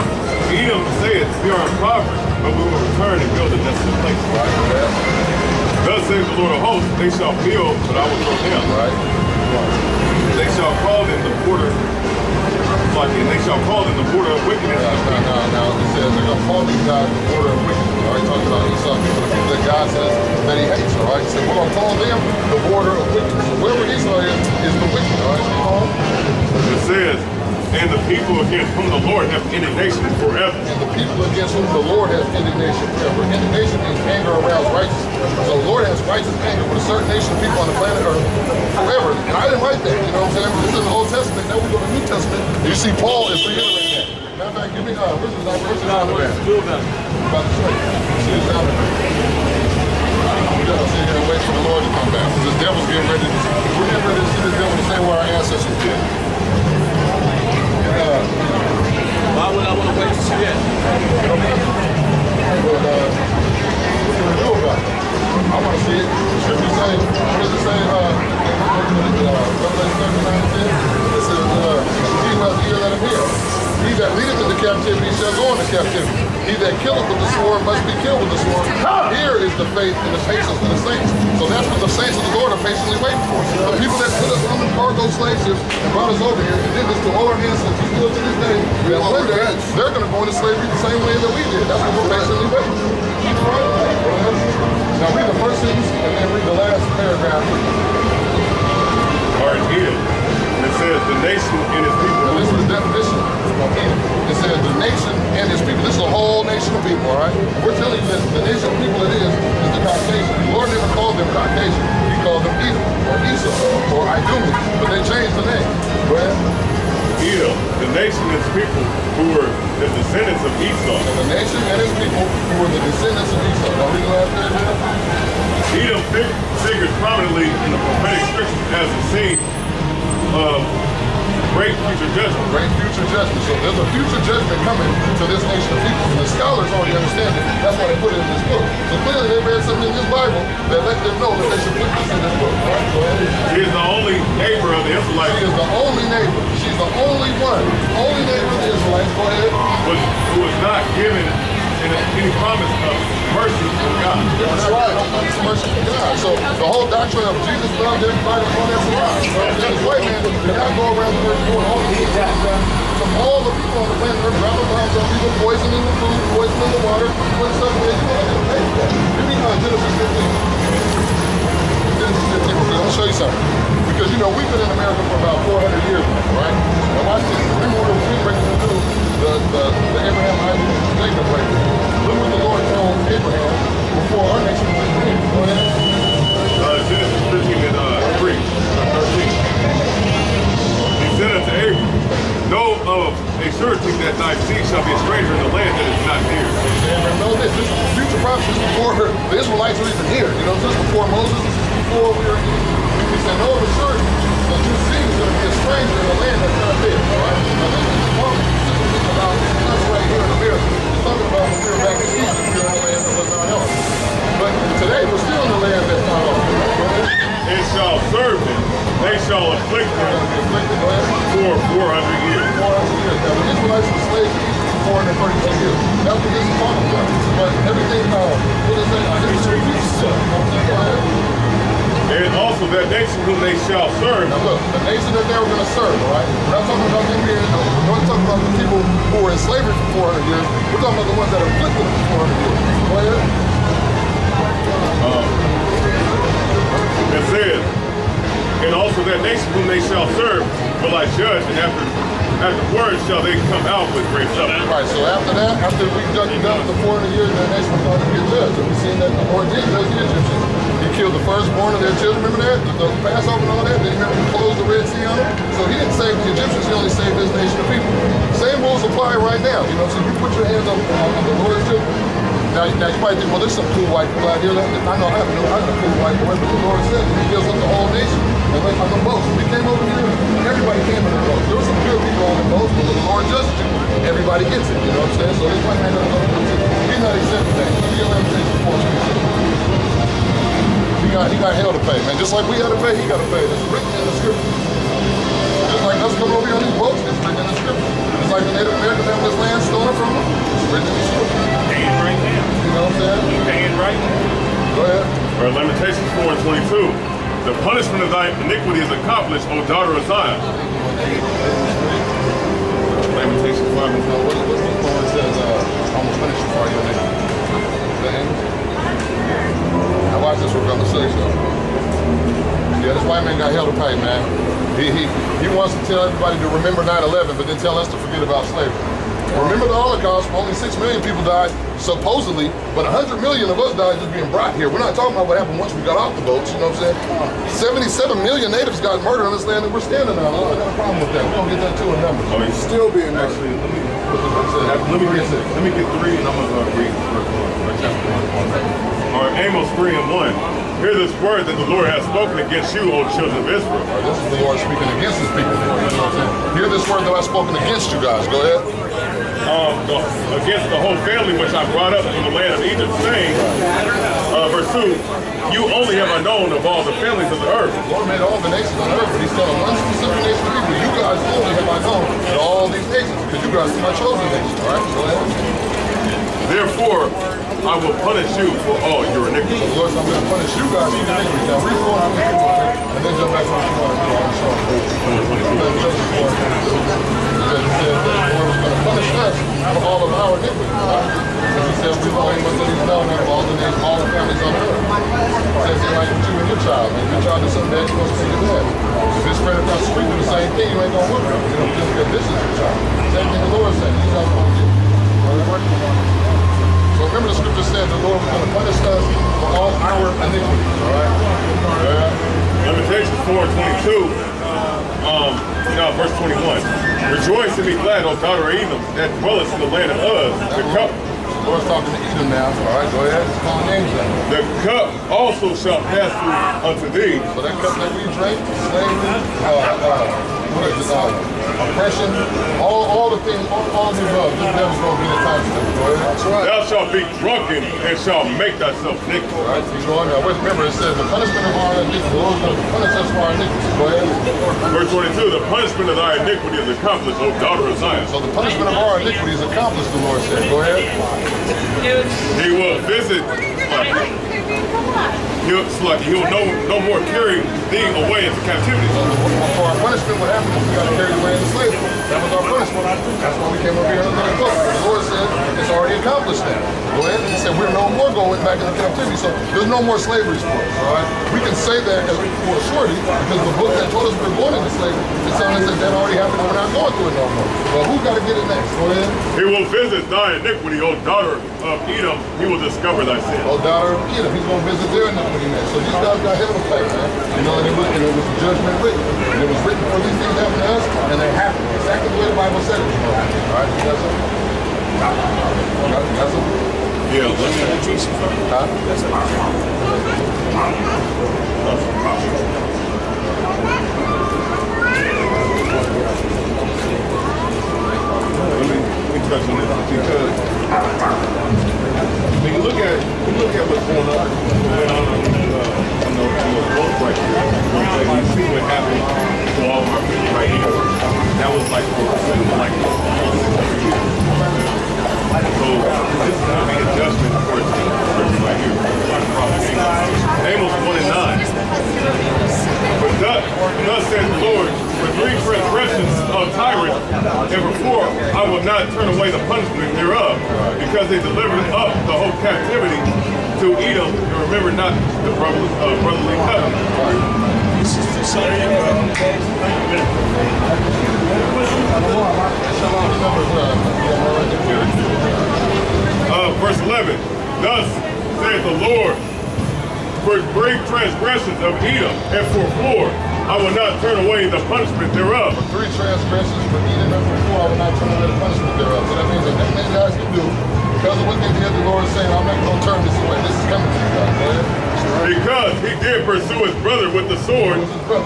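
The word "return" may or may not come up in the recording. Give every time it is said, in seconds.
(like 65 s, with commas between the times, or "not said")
2 s.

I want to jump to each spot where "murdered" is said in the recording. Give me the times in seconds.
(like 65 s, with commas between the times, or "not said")
339 s, 343 s.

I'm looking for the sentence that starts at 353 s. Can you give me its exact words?
Right, this is the Lord speaking against his people.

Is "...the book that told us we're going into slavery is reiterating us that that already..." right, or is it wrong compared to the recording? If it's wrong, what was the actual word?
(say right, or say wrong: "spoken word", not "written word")
wrong: "telling", not "reiterating".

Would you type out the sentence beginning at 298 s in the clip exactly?
It's like the Native Americans have this land stolen from them.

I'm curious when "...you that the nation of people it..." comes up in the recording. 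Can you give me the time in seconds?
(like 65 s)
107 s.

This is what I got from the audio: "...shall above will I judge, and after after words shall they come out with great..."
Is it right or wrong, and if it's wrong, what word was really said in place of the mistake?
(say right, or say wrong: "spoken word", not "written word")
wrong: "serve", not "above".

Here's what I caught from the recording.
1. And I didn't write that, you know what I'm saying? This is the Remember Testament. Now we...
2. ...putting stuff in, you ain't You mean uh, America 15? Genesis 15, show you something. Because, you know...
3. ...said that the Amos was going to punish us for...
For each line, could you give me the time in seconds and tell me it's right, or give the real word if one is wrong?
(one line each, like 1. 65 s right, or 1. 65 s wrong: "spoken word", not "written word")
1. 39 s wrong: "Old", not "Remember"
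2. 167 s wrong: "Genesis", not "America"
3. 387 s wrong: "Lord", not "Amos".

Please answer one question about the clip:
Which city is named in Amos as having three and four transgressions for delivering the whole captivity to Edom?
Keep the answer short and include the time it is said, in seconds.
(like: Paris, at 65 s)
Tyrus, at 536 s.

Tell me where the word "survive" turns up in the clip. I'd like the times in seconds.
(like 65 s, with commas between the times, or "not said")
158 s.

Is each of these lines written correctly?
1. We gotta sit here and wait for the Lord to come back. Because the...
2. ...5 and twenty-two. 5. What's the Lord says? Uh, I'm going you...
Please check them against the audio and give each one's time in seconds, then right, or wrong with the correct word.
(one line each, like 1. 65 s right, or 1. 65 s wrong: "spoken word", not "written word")
1. 50 s right
2. 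313 s wrong: "4", not "5".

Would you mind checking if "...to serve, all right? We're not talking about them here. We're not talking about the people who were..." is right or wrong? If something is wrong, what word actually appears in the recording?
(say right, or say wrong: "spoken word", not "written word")
right.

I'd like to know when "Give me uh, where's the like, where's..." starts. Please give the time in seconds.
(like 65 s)
44 s.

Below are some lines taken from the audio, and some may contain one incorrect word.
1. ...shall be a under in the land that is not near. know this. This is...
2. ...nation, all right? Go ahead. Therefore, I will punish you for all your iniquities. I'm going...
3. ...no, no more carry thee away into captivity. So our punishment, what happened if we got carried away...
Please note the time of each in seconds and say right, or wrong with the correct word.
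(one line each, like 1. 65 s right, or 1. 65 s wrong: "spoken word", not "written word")
1. 194 s wrong: "stranger", not "under"
2. 374 s right
3. 456 s right.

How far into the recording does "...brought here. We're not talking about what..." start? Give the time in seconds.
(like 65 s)
334 s.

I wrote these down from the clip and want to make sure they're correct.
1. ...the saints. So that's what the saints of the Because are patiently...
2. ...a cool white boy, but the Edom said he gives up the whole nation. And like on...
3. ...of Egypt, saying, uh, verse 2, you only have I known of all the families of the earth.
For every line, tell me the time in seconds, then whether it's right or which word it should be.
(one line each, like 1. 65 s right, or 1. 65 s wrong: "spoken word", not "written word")
1. 80 s wrong: "Lord", not "Because"
2. 275 s wrong: "Lord", not "Edom"
3. 362 s right.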